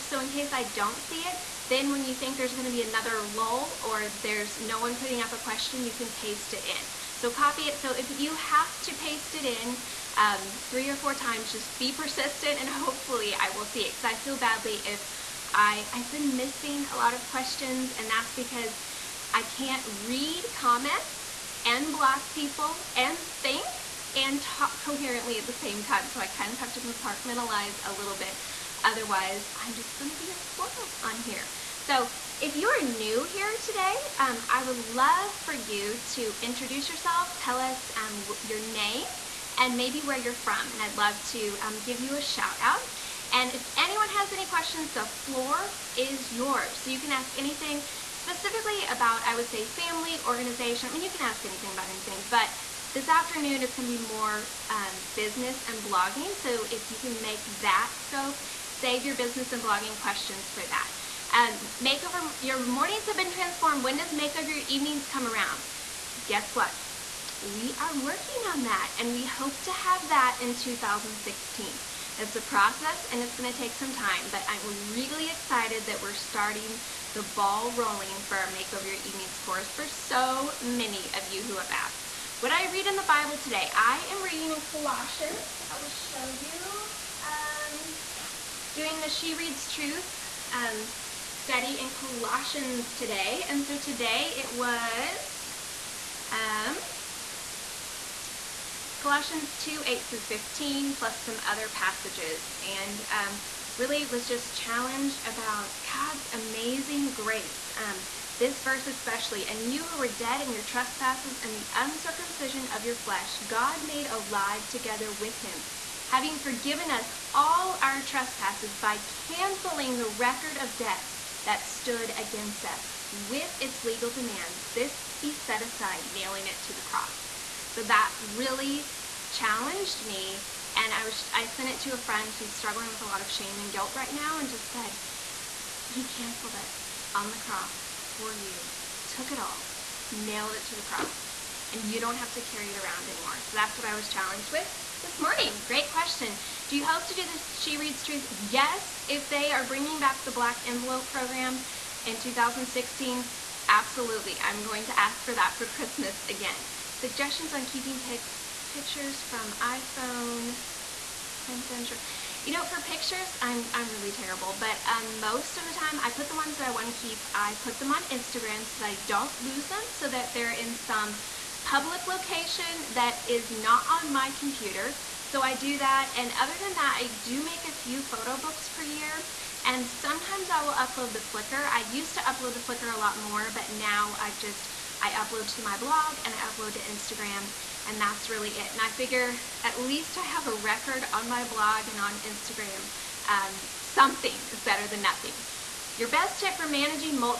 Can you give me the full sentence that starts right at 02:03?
With its legal demands, this he set aside, nailing it to the cross.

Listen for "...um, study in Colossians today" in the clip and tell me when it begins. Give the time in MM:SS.
01:30.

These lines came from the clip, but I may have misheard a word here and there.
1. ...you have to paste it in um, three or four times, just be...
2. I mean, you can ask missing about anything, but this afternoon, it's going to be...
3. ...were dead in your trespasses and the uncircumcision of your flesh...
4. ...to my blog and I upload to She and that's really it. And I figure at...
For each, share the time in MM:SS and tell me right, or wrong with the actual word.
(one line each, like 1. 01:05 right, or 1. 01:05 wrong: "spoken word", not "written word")
1. 00:08 right
2. 00:50 wrong: "anything", not "missing"
3. 01:49 right
4. 03:05 wrong: "Instagram", not "She".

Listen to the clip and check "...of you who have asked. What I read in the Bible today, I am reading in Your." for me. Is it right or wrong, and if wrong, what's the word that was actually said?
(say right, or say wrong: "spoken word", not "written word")
wrong: "Colossians", not "Your".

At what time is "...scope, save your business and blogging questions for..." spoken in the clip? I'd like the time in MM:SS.
00:58.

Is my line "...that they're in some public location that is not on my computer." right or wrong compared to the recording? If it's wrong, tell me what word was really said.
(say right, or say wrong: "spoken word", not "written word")
right.